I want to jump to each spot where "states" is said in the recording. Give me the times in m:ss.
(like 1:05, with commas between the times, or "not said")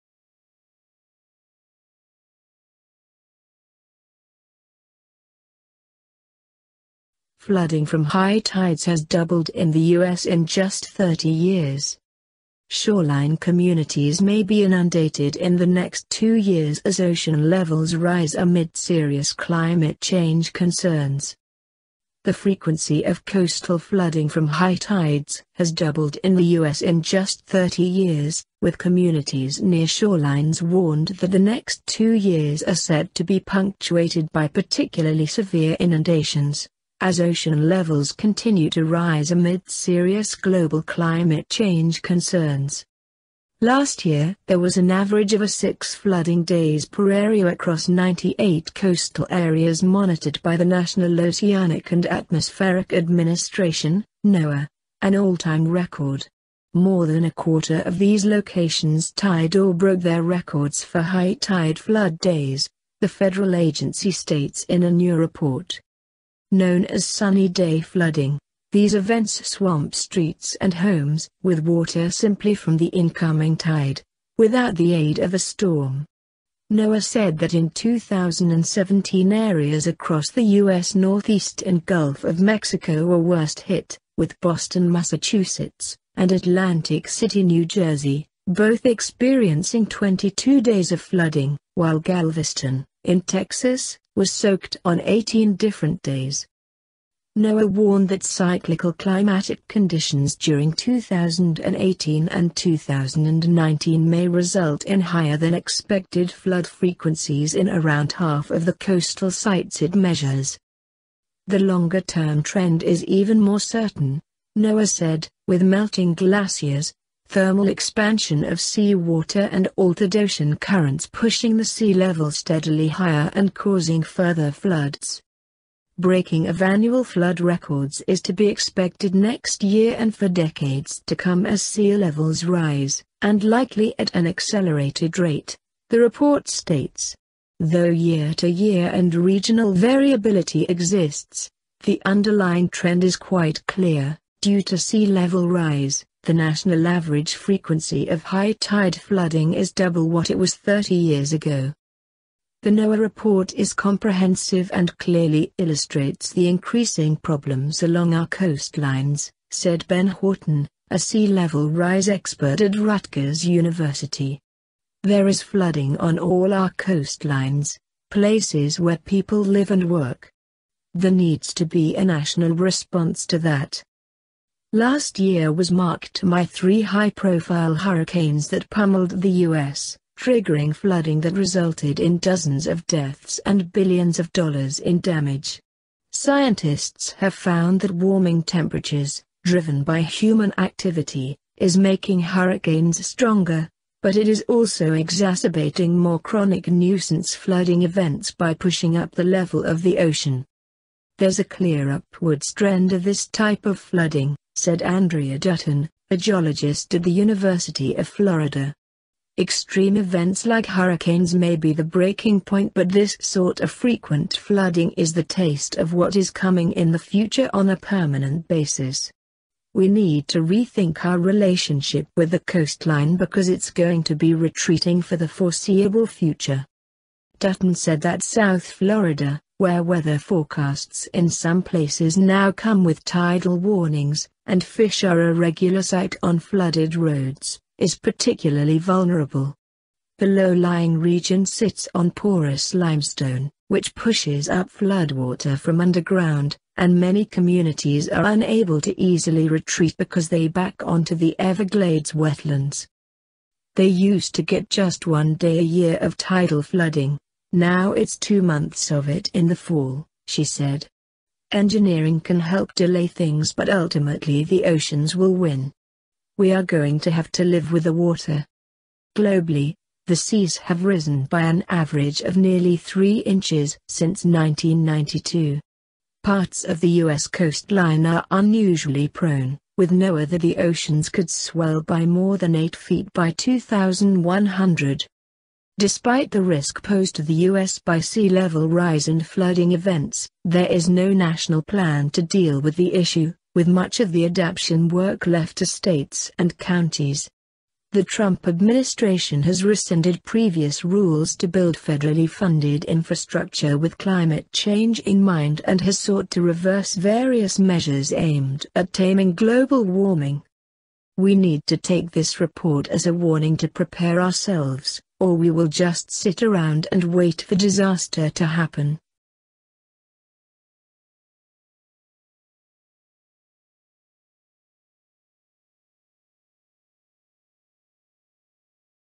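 1:04, 2:16, 4:55.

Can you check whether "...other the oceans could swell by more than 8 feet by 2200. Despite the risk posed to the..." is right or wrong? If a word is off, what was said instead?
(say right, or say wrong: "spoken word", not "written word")
wrong: "2100", not "2200".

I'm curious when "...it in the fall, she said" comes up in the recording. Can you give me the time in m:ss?
4:19.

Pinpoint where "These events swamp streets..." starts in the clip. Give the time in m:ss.
1:08.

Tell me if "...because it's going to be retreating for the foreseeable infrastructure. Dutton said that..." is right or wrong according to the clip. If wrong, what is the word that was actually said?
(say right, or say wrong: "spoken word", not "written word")
wrong: "future", not "infrastructure".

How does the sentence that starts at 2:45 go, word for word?
There is flooding on all our coastlines, places where people live and work.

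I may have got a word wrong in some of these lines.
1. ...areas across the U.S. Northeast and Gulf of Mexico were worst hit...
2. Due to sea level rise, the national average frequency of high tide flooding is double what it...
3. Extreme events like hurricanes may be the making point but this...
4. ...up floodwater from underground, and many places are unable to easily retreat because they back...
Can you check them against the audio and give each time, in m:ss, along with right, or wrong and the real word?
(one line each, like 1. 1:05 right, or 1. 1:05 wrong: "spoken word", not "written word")
1. 1:19 right
2. 2:24 right
3. 3:29 wrong: "breaking", not "making"
4. 4:04 wrong: "communities", not "places".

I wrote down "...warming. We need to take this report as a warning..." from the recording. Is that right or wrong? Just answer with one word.
right.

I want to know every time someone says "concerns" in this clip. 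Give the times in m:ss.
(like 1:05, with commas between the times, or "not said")
0:20, 0:42.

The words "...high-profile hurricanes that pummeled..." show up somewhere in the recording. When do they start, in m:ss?
2:56.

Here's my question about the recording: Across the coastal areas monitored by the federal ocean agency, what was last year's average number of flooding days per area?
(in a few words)
6.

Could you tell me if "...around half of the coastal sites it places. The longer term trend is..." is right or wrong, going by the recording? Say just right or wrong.
wrong.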